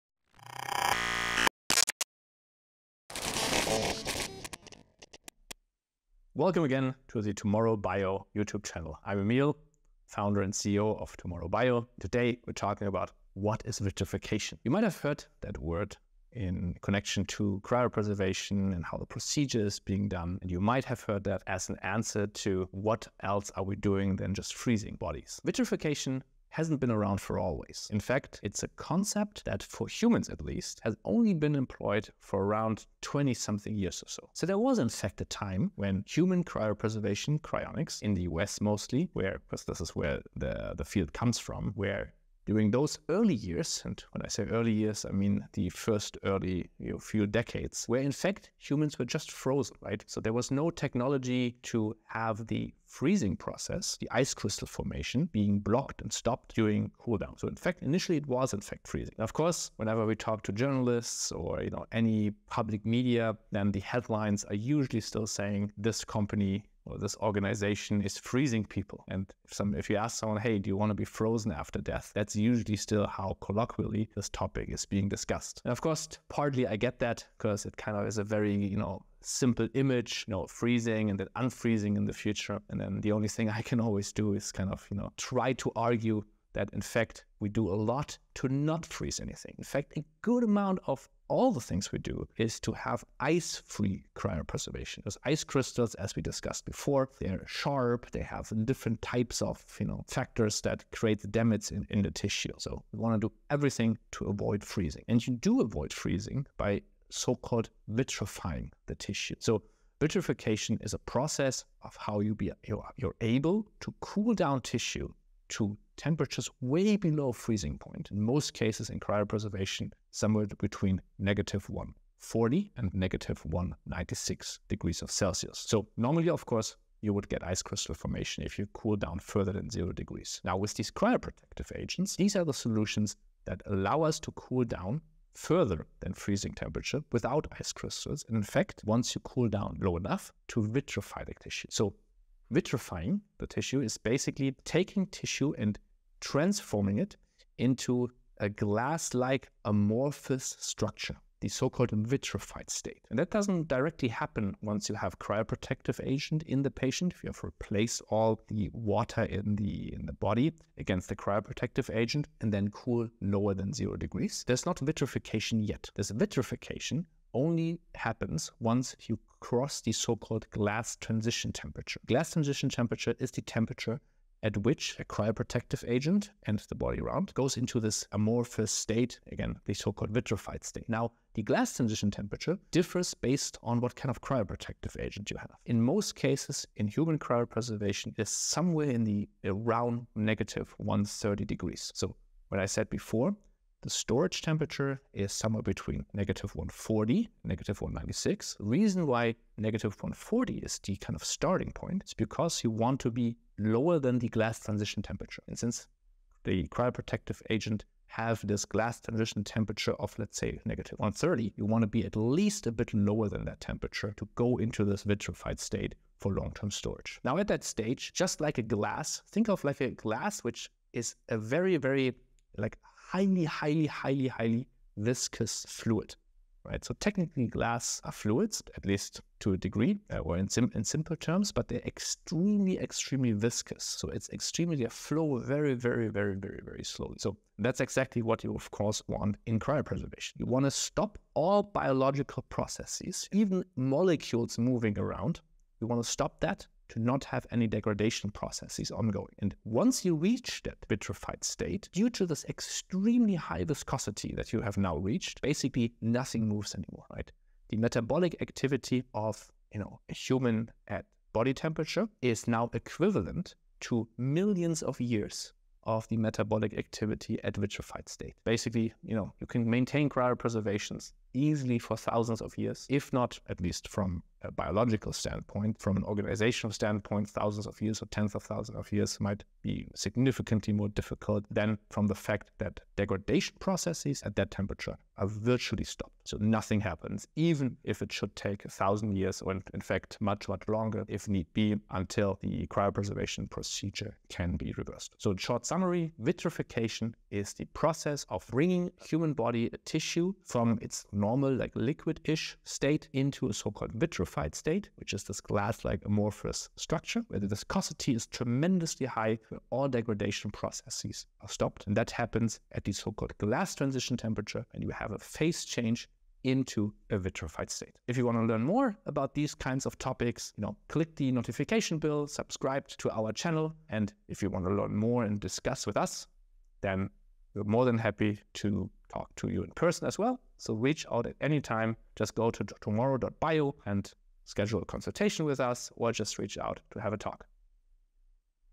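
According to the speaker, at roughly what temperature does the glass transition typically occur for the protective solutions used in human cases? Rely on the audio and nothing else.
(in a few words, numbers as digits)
-130 degrees.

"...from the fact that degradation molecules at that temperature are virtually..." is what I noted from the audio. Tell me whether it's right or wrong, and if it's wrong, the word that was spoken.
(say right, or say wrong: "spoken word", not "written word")
wrong: "processes", not "molecules".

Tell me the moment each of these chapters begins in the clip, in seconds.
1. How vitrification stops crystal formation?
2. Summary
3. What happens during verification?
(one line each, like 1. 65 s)
1. 80 s
2. 290 s
3. 218 s.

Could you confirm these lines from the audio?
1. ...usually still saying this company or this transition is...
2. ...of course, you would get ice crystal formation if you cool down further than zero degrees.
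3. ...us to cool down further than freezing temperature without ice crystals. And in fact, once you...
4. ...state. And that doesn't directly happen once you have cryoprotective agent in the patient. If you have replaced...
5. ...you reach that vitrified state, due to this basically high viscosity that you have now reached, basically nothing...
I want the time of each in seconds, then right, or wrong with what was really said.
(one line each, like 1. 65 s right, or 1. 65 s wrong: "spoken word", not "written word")
1. 64 s wrong: "organization", not "transition"
2. 126 s right
3. 134 s right
4. 152 s right
5. 250 s wrong: "extremely", not "basically".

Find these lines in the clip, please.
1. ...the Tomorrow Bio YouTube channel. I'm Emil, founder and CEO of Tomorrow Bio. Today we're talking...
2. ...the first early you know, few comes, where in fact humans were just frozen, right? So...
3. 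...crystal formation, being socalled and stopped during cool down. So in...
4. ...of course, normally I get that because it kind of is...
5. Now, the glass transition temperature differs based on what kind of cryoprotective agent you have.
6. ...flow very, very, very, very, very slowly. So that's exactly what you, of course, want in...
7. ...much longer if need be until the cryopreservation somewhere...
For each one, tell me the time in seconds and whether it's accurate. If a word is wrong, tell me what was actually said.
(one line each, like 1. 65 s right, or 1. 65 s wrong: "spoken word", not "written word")
1. 7 s right
2. 45 s wrong: "decades", not "comes"
3. 54 s wrong: "blocked", not "socalled"
4. 75 s wrong: "partly", not "normally"
5. 180 s right
6. 234 s right
7. 290 s wrong: "procedure", not "somewhere".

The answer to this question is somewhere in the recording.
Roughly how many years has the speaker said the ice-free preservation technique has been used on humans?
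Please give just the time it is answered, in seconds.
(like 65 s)
33 s.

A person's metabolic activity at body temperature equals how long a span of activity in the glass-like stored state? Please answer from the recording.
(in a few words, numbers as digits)
millions of years.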